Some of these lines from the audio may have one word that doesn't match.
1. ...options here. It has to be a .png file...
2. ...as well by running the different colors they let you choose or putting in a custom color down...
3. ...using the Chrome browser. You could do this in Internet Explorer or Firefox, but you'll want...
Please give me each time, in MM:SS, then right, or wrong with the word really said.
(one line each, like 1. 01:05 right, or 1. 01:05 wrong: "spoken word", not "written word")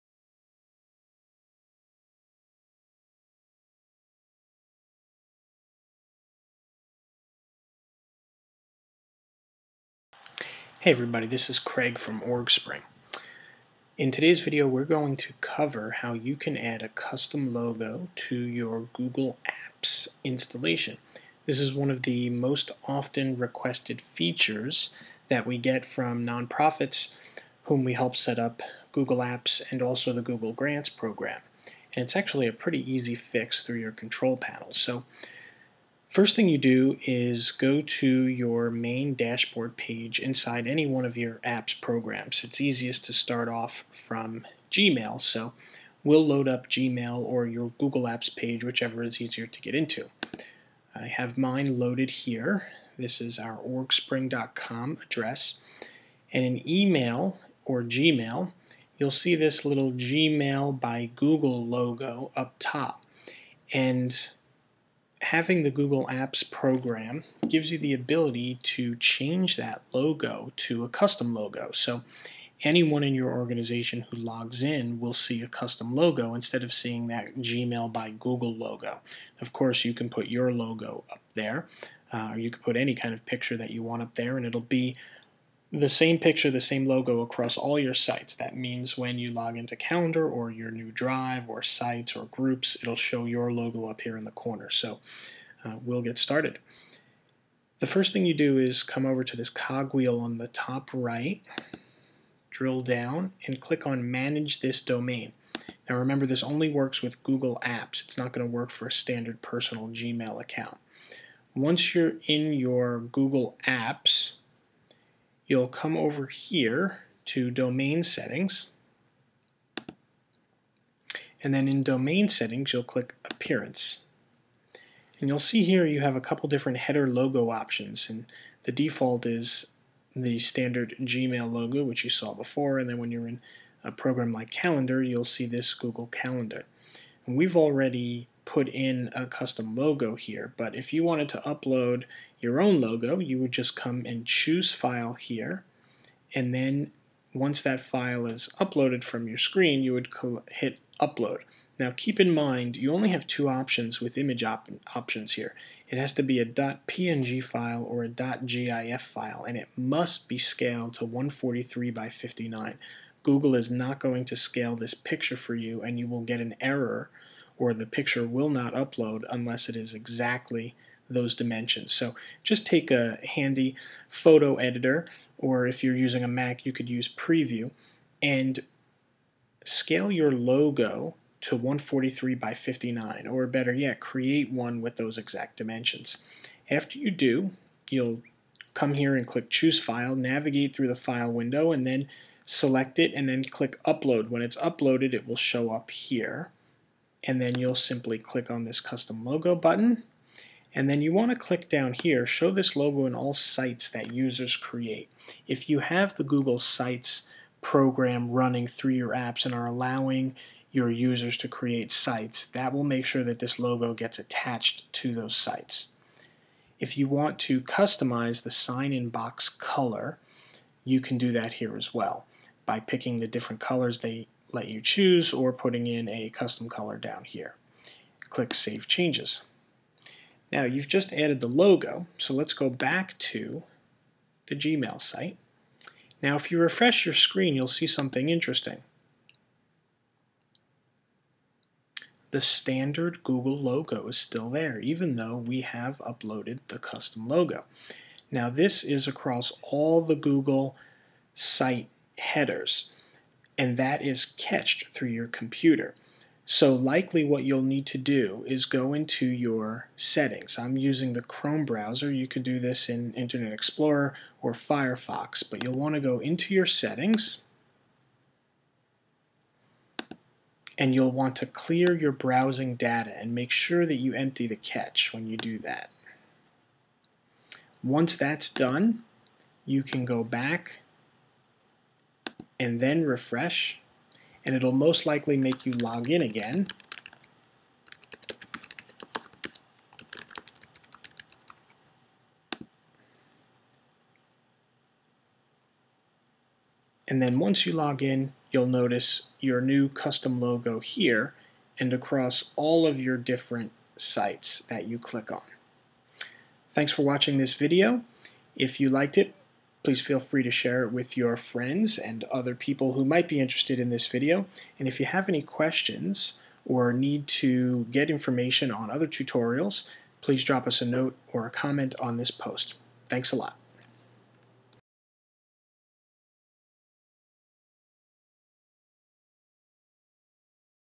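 1. 02:34 right
2. 03:41 wrong: "picking", not "running"
3. 04:20 right.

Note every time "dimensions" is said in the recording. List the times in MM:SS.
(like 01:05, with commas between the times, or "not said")
02:51, 03:05.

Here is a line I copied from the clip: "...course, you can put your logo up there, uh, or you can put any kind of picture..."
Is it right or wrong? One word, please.
right.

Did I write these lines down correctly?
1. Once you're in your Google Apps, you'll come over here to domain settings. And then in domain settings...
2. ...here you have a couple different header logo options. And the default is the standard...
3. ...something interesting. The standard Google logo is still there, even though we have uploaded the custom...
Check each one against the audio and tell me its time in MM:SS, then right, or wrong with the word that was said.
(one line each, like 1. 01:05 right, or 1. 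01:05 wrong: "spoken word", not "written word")
1. 01:51 right
2. 02:05 right
3. 03:57 right.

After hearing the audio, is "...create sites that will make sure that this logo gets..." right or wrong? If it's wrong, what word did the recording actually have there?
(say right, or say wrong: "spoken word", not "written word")
right.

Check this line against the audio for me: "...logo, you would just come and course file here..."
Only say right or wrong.
wrong.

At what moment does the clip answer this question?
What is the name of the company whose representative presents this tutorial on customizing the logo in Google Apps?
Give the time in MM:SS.
00:12.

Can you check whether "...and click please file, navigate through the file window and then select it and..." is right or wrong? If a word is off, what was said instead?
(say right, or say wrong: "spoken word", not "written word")
wrong: "choose", not "please".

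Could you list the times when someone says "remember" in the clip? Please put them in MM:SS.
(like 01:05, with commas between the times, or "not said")
01:45.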